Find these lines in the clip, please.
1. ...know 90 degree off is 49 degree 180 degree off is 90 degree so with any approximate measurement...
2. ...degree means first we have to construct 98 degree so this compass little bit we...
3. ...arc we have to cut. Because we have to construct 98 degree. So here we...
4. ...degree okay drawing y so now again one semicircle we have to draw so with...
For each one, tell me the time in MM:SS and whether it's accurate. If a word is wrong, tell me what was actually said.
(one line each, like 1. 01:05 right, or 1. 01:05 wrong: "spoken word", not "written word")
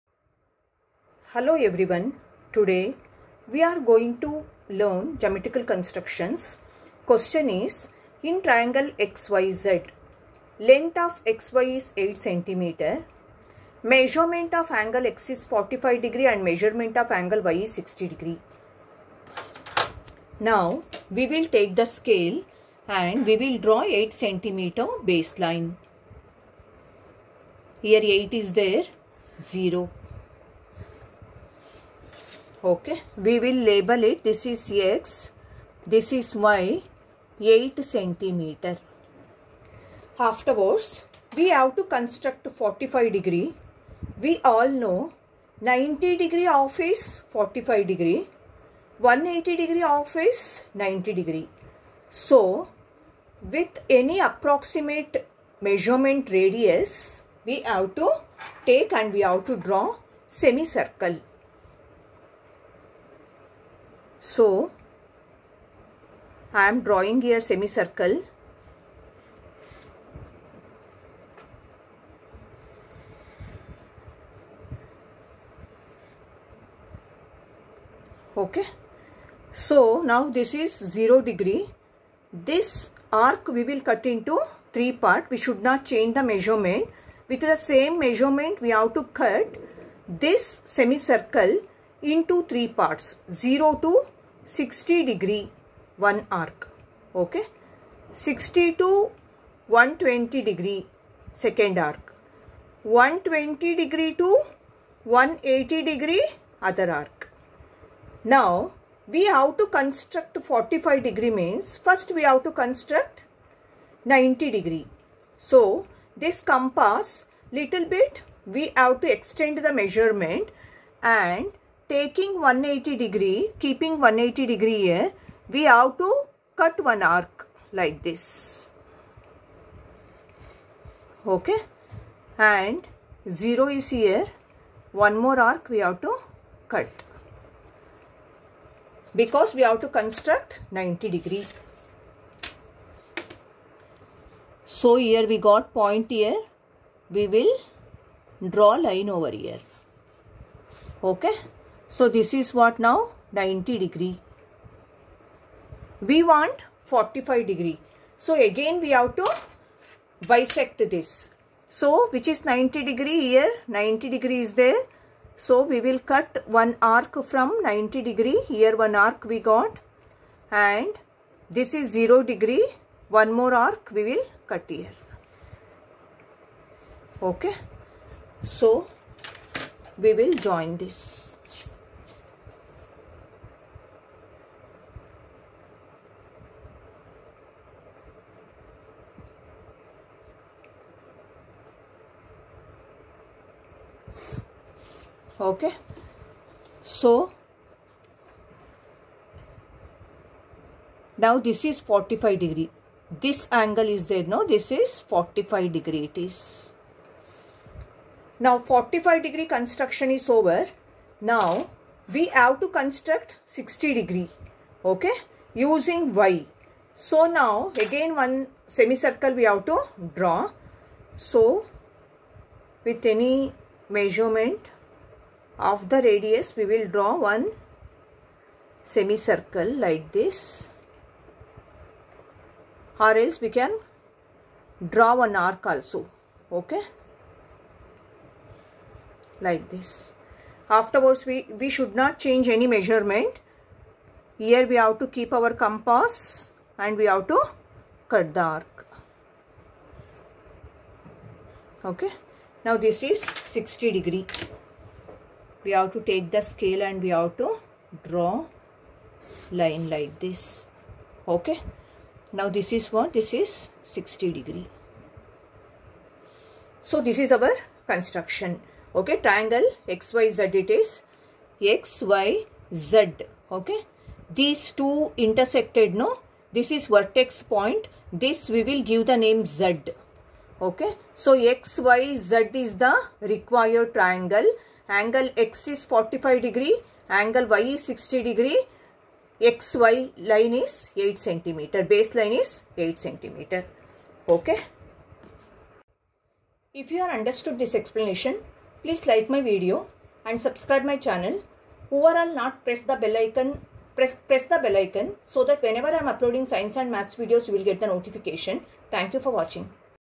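1. 00:44 wrong: "45", not "49"
2. 01:51 wrong: "90", not "98"
3. 02:15 wrong: "90", not "98"
4. 03:33 wrong: "using", not "drawing".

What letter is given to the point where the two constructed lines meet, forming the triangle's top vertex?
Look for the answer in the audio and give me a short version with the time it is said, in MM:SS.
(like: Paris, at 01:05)
Z, at 04:39.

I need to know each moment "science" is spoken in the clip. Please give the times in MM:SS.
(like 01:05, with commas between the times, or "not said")
05:06.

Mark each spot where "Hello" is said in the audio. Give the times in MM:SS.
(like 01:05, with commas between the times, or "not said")
00:01.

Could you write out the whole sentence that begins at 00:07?
Question is in triangle XYZ length of XY is 8 cm.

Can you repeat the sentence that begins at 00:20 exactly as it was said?
Now we will take the scale and we will draw 8 cm baseline.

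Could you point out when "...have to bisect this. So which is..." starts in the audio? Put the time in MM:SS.
02:38.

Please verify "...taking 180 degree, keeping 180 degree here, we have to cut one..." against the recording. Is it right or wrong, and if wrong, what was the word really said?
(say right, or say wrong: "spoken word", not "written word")
right.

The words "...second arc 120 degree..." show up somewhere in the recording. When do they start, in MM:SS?
01:41.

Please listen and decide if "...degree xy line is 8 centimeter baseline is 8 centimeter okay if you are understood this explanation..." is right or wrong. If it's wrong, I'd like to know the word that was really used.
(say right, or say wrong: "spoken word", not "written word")
right.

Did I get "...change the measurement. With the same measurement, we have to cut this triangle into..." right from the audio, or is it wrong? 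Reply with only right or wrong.
wrong.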